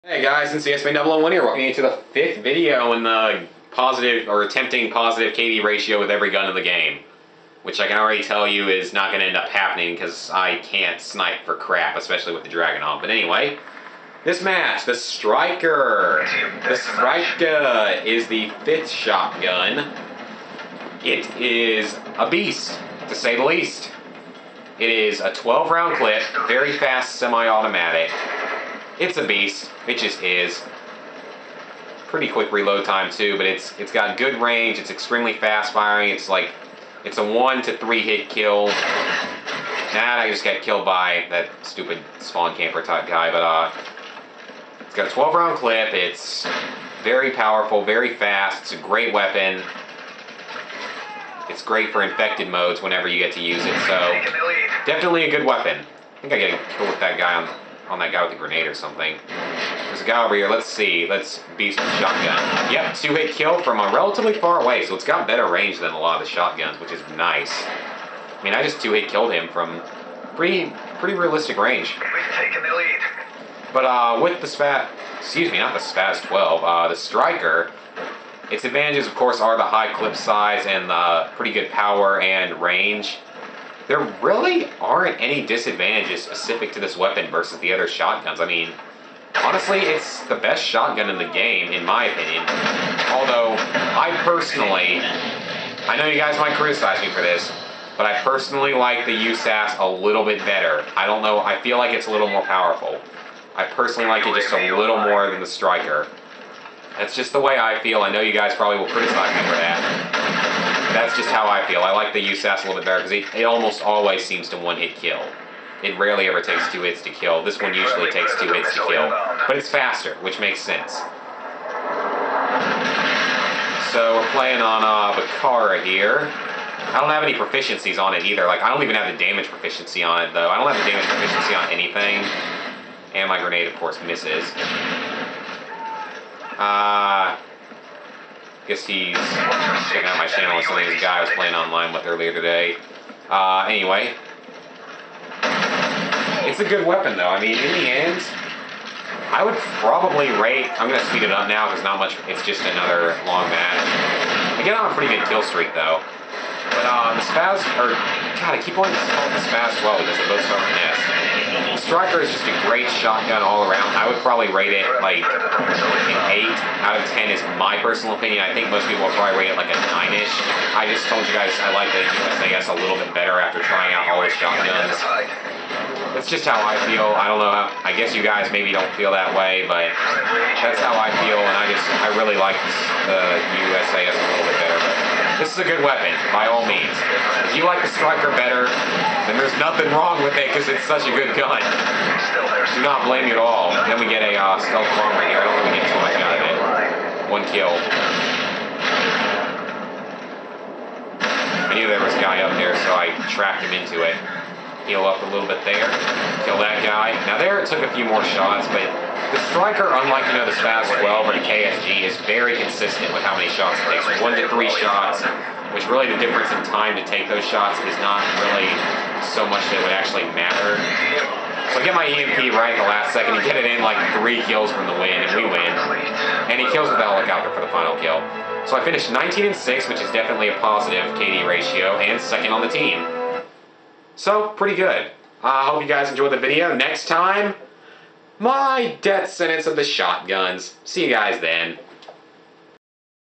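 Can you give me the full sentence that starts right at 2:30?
I'm gonna speed it up now because not much.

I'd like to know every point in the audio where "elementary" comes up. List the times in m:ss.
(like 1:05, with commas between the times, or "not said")
not said.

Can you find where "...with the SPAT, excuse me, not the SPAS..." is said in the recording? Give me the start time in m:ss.
1:14.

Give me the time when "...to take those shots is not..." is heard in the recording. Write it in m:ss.
3:36.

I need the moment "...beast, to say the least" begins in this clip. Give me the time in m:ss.
0:22.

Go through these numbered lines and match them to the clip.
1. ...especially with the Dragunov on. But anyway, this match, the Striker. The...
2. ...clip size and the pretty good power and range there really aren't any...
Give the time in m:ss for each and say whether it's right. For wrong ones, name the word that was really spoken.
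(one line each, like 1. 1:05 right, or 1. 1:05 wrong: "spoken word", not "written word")
1. 0:11 right
2. 1:19 right.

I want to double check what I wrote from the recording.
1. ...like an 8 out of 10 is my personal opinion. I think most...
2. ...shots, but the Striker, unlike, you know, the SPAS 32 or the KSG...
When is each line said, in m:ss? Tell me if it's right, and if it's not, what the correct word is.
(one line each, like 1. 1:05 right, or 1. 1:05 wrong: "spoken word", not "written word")
1. 2:45 right
2. 3:28 wrong: "12", not "32".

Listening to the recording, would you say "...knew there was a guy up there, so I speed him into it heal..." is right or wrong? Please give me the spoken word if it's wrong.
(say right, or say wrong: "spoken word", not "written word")
wrong: "tracked", not "speed".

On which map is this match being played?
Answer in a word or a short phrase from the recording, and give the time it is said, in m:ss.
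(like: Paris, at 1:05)
Bakaara, at 2:05.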